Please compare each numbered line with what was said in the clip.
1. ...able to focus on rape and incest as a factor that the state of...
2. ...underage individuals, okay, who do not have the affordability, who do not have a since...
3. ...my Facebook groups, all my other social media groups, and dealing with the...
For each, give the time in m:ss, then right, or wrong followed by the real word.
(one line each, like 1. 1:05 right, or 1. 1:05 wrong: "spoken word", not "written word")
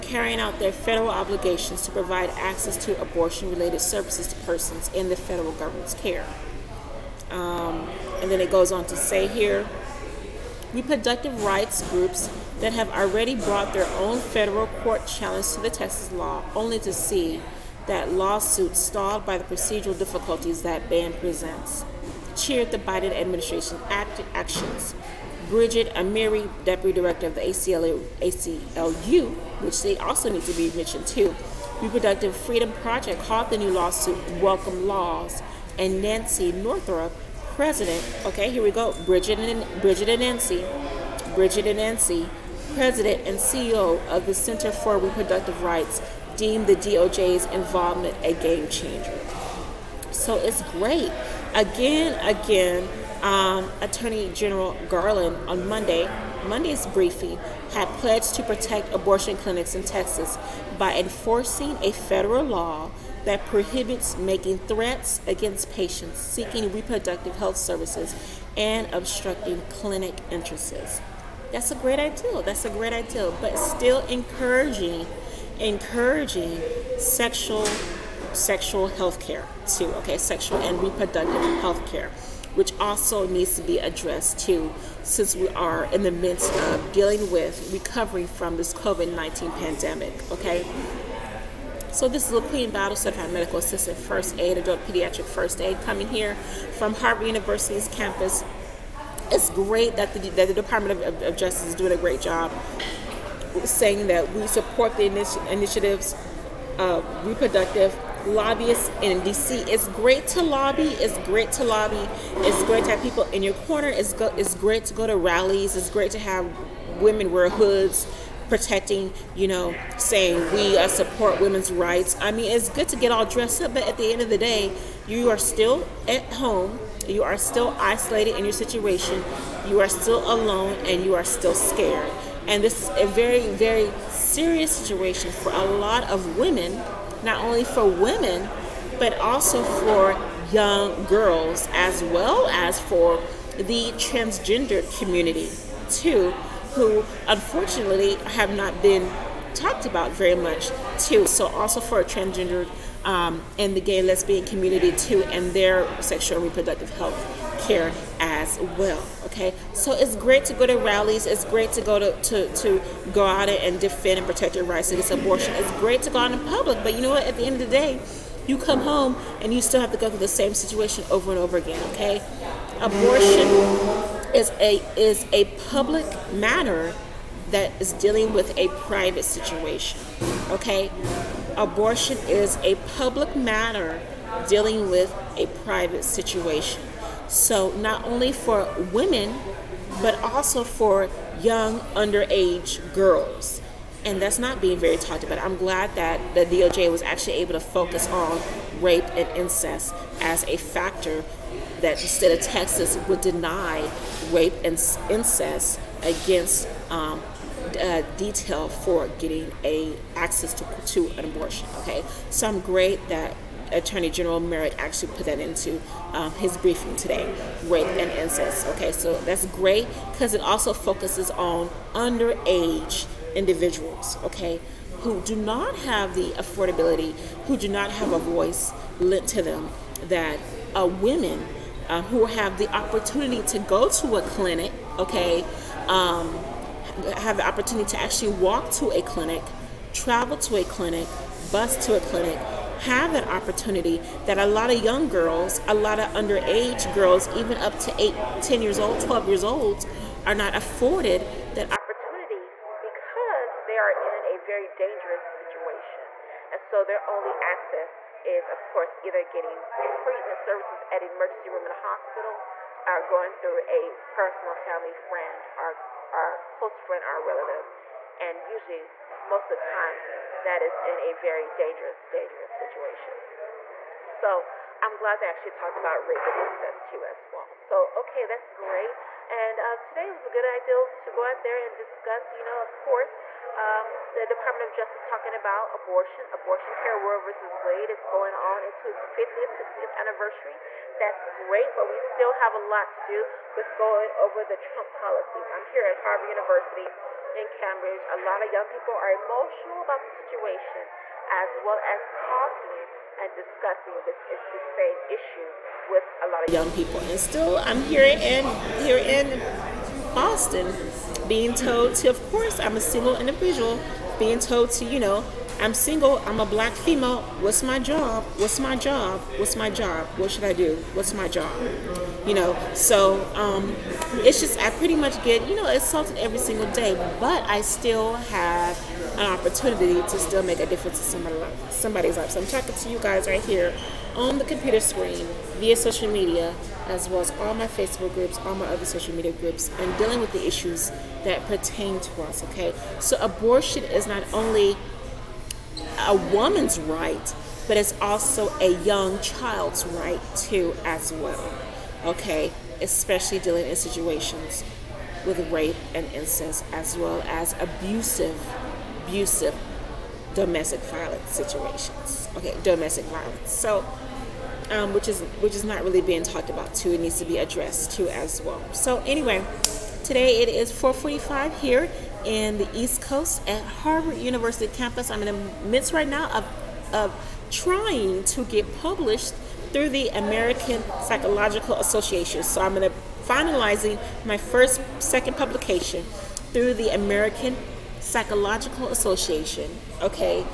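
1. 3:17 right
2. 3:41 wrong: "voice", not "since"
3. 5:37 right.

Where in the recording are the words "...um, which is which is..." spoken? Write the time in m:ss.
6:04.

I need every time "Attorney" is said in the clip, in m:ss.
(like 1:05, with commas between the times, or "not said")
0:53, 3:33.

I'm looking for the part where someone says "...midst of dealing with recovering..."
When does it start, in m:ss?
1:26.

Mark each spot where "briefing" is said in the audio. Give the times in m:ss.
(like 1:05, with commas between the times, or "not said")
0:56, 3:36.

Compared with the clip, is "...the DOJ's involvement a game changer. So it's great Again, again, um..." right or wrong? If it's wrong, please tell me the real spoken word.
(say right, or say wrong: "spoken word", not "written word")
right.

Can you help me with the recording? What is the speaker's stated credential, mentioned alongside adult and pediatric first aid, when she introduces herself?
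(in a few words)
certified medical assistant.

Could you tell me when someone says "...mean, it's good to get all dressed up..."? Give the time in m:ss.
2:02.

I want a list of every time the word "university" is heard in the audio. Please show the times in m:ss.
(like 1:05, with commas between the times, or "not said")
1:37, 4:56, 6:14.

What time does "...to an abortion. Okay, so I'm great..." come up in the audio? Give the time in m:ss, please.
3:30.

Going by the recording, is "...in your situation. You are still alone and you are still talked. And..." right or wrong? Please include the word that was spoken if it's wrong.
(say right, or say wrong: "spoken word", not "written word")
wrong: "scared", not "talked".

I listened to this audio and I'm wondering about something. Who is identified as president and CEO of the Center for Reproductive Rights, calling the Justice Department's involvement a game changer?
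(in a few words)
Nancy Northrup.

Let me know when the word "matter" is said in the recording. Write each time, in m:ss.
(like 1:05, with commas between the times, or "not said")
2:56, 3:03.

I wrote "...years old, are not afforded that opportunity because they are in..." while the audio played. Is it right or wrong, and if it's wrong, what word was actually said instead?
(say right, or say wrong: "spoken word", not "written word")
right.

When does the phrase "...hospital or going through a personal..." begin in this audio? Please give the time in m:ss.
4:21.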